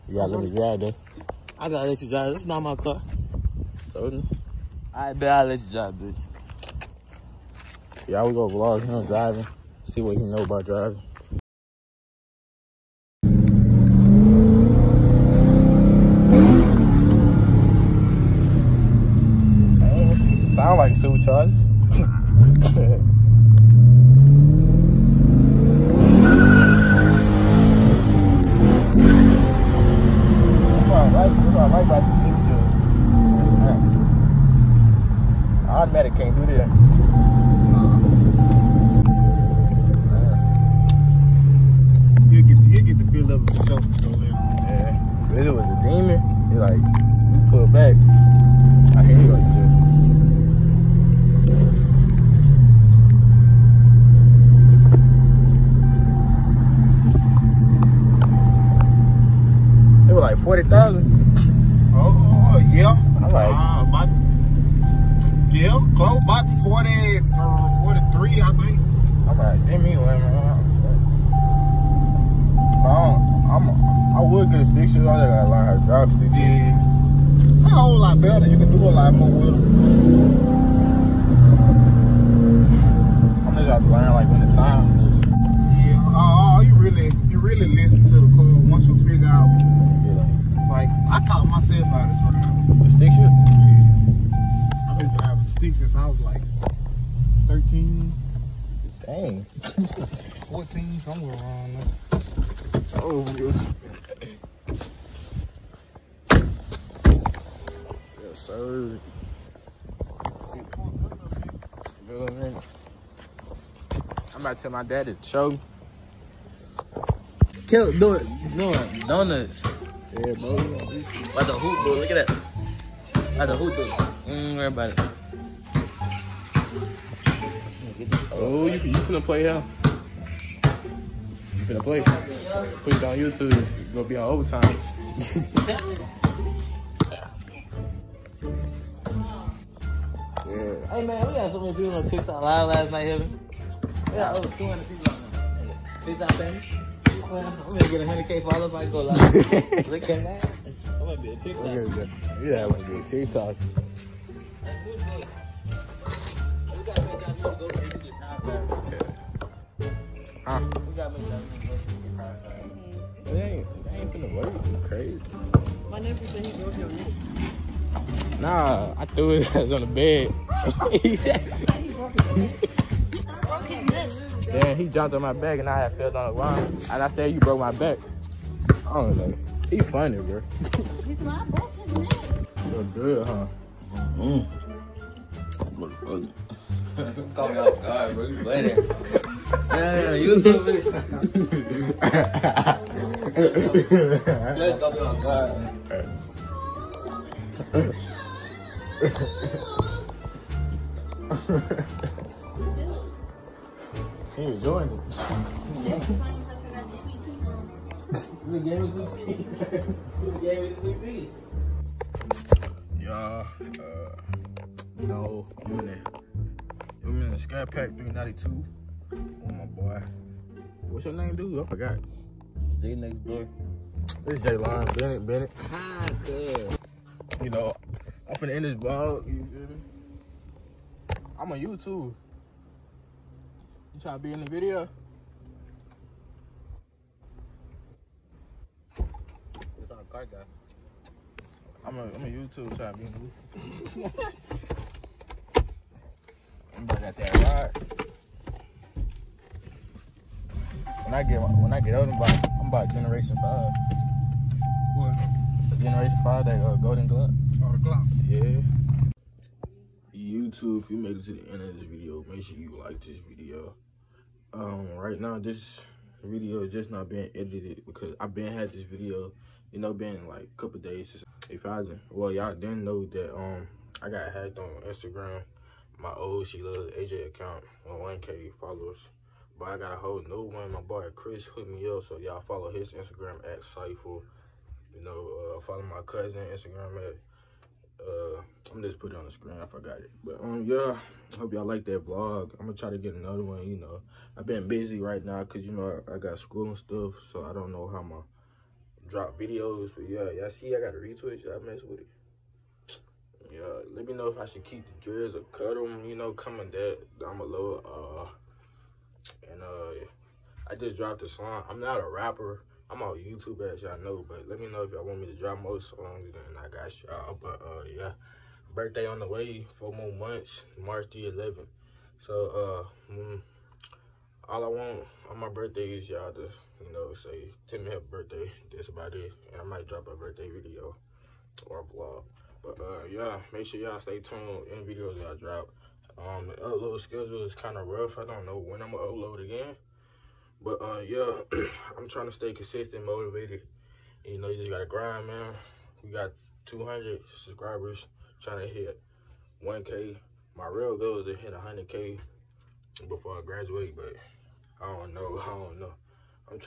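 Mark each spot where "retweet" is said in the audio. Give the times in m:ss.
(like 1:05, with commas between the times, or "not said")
5:00.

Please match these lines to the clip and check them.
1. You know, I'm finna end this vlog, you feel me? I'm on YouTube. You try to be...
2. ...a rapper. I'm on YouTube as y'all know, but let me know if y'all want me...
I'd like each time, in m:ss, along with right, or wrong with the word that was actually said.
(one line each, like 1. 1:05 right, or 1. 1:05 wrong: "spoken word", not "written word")
1. 3:47 right
2. 5:11 right.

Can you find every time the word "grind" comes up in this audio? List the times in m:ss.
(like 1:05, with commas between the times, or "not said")
5:44.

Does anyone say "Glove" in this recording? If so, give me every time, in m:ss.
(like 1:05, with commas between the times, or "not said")
4:17.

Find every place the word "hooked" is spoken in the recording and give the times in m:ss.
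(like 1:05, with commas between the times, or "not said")
4:41.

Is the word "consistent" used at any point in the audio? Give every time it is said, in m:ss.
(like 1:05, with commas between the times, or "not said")
5:42.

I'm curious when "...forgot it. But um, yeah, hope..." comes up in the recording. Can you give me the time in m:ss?
4:49.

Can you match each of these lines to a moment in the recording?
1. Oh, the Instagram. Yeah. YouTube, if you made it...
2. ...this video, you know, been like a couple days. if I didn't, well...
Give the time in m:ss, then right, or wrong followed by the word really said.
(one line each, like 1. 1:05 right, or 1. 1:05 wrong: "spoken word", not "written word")
1. 4:17 wrong: "Glock", not "Instagram"
2. 4:28 right.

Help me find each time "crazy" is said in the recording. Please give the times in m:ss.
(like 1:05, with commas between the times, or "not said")
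2:44.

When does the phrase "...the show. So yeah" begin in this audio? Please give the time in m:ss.
0:43.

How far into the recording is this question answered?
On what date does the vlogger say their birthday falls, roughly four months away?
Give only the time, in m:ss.
5:20.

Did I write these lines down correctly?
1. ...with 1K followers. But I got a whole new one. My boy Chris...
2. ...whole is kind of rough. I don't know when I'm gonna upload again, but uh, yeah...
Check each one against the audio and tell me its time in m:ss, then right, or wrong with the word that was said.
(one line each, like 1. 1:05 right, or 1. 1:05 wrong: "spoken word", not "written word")
1. 4:37 right
2. 5:36 wrong: "schedule", not "whole".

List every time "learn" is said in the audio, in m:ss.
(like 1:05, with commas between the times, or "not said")
1:15, 1:23.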